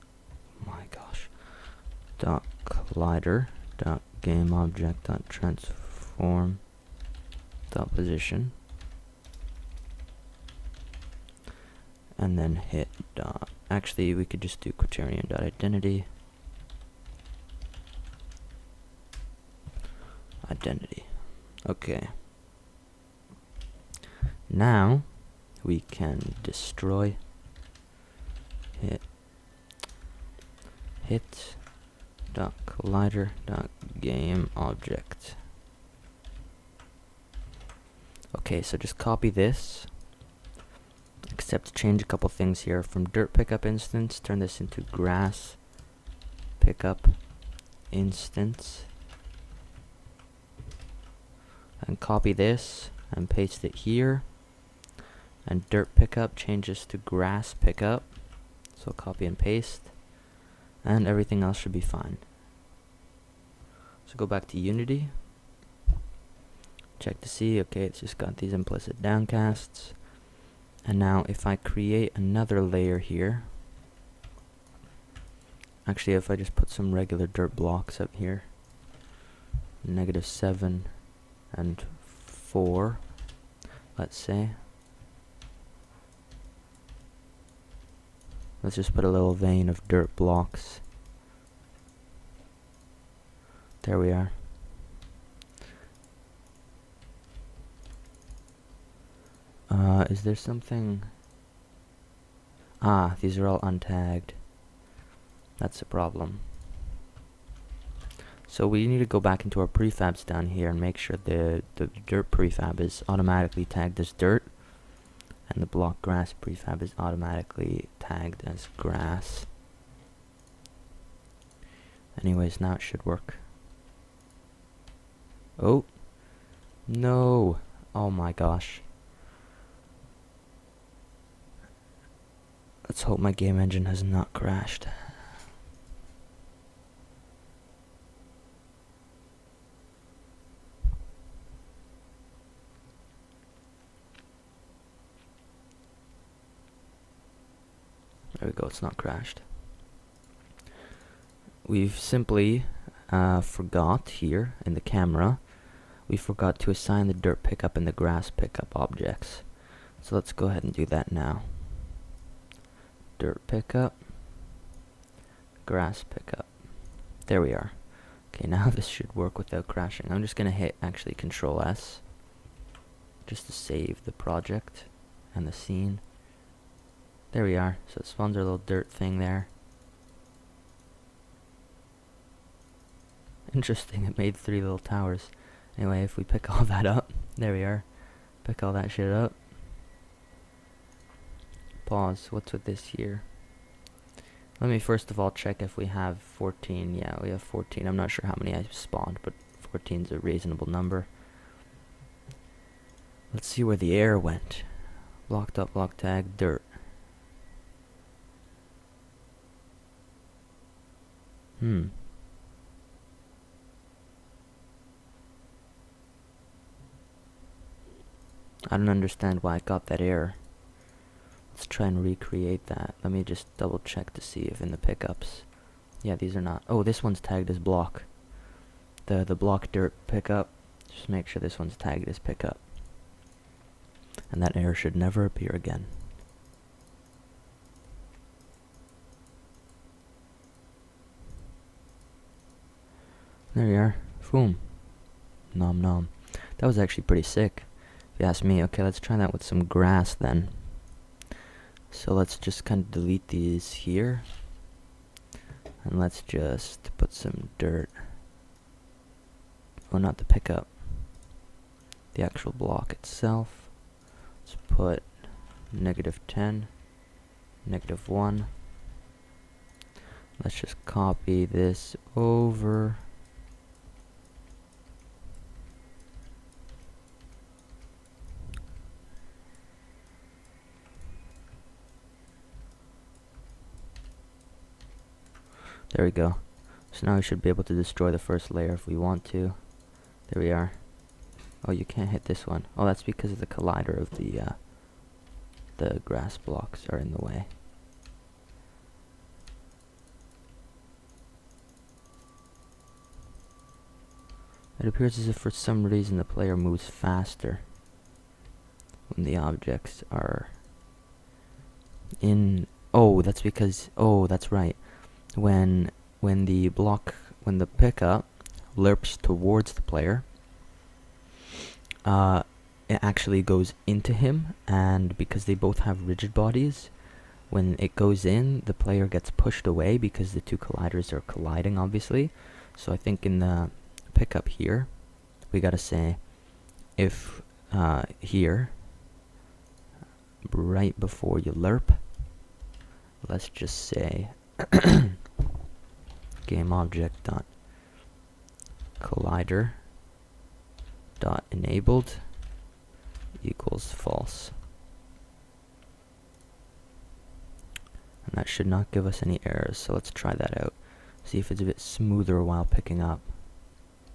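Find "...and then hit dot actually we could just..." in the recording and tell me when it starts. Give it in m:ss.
0:12.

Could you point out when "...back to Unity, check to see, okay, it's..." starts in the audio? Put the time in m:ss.
1:04.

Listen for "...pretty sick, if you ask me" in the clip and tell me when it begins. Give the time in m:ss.
4:07.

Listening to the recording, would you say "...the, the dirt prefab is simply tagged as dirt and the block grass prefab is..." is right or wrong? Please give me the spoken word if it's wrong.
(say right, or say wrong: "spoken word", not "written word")
wrong: "automatically", not "simply".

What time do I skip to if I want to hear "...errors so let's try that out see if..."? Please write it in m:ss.
5:59.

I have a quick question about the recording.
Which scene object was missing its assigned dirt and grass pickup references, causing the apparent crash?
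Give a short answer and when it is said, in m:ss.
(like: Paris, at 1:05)
The camera, at 2:34.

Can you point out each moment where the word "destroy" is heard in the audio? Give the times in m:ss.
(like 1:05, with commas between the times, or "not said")
0:26, 4:47.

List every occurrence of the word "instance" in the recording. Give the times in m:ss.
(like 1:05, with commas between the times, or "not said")
0:43, 0:47.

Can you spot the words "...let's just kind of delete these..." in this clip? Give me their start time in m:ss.
4:12.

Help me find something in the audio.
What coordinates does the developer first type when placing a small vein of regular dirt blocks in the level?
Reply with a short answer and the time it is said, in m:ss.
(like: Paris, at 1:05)
-7 and 4, at 1:19.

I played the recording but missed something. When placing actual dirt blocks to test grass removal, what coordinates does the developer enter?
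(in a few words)
-10, -1.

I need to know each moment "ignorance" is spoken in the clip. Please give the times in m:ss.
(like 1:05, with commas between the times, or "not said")
not said.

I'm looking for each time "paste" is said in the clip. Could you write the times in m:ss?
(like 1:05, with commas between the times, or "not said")
0:53, 0:59.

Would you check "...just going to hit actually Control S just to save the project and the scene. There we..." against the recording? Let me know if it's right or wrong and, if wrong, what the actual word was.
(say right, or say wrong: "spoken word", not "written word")
right.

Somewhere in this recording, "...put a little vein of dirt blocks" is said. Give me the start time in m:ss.
1:28.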